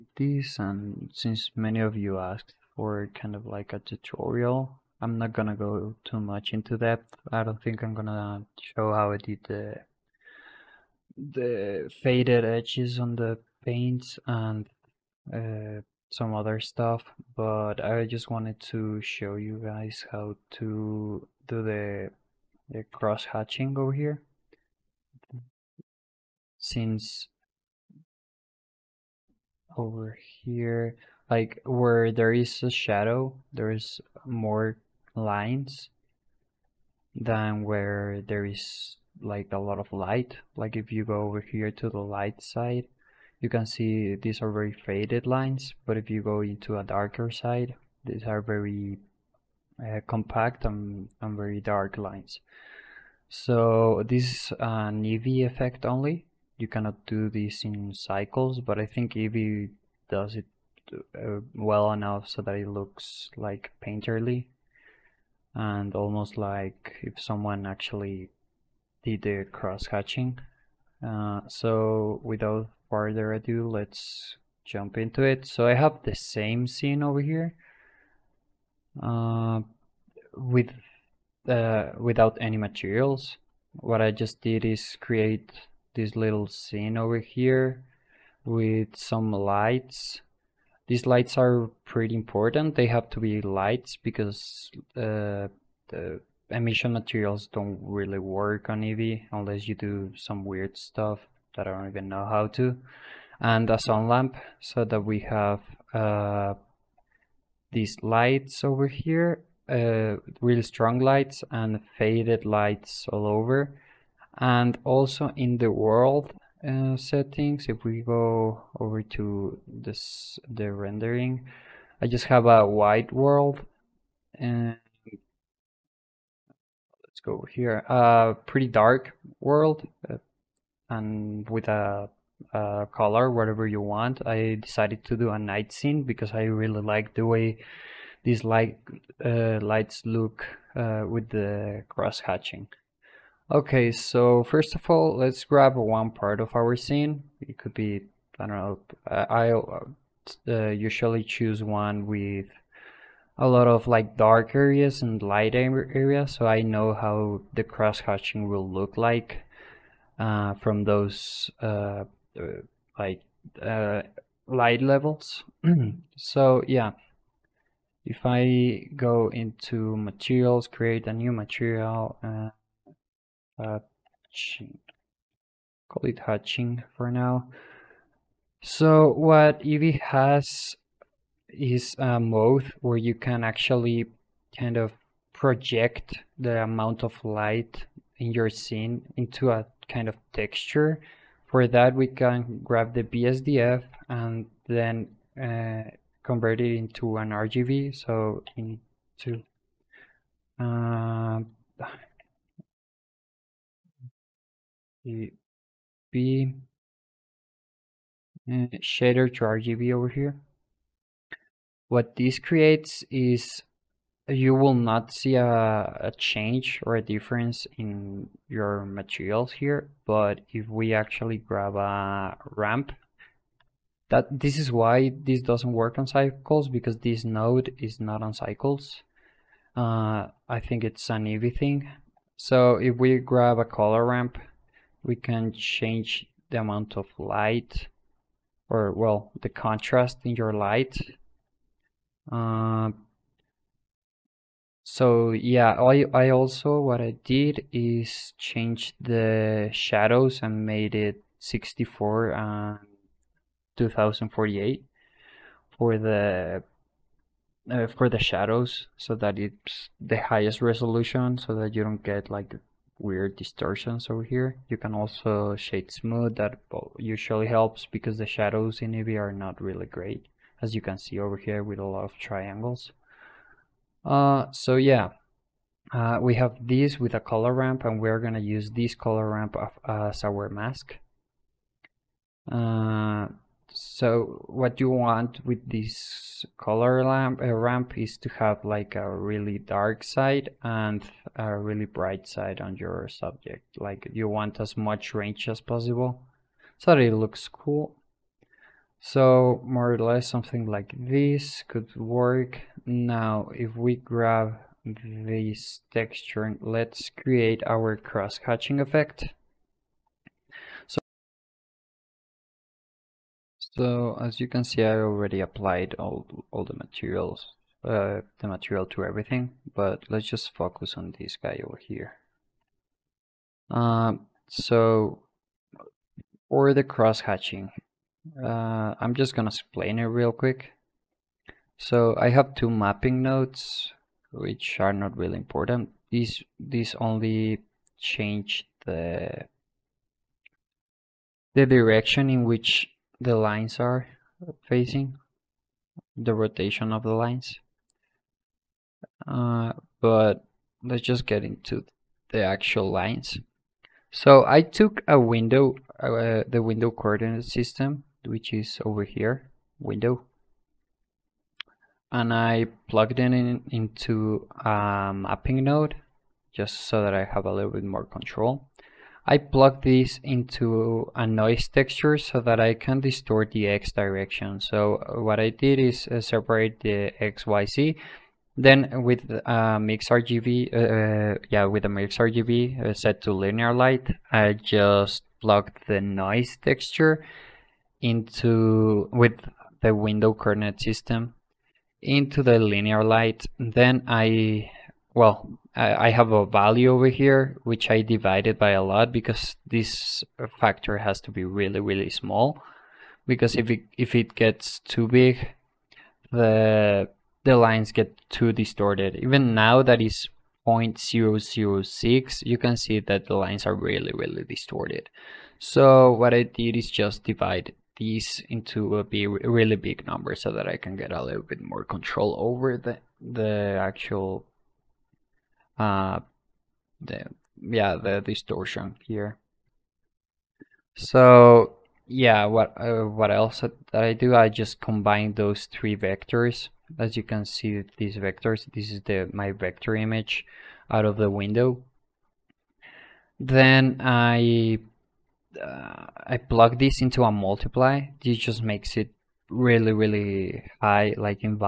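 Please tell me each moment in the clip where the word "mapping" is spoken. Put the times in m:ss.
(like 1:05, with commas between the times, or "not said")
5:32, 6:05.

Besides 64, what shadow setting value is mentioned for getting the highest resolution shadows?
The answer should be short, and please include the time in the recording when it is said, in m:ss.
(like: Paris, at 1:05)
2048, at 4:13.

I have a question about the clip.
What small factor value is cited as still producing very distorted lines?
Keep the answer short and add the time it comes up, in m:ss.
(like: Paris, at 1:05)
0.006, at 6:50.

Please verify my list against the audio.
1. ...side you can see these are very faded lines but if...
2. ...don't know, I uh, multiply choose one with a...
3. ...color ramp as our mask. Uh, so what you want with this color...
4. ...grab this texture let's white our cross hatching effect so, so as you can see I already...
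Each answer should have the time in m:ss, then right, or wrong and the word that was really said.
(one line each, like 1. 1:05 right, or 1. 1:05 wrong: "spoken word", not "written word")
1. 0:42 right
2. 2:28 wrong: "usually", not "multiply"
3. 4:38 right
4. 5:03 wrong: "create", not "white".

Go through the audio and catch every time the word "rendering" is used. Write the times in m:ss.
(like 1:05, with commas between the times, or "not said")
2:00.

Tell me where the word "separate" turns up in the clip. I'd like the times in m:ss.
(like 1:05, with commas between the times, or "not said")
6:16.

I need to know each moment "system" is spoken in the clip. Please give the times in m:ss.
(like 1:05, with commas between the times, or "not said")
5:57, 6:30.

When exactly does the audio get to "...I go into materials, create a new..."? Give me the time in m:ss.
2:48.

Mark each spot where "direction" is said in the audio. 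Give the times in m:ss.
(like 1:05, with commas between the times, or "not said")
5:41, 6:13.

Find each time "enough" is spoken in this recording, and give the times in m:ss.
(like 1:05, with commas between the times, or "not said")
1:01.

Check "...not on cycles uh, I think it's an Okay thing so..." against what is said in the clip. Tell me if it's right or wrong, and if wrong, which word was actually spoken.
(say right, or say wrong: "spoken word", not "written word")
wrong: "Eevee", not "Okay".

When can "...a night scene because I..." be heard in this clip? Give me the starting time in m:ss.
2:15.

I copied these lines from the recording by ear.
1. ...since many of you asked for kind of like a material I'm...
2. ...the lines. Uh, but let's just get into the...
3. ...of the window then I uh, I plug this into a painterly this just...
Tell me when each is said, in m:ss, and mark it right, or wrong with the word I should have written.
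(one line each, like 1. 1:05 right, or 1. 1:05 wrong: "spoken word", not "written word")
1. 0:01 wrong: "tutorial", not "material"
2. 5:47 right
3. 7:21 wrong: "multiply", not "painterly".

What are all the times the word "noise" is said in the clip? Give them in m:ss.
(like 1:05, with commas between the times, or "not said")
6:11, 6:26.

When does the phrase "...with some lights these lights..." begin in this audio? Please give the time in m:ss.
1:28.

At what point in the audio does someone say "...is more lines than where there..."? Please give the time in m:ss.
0:33.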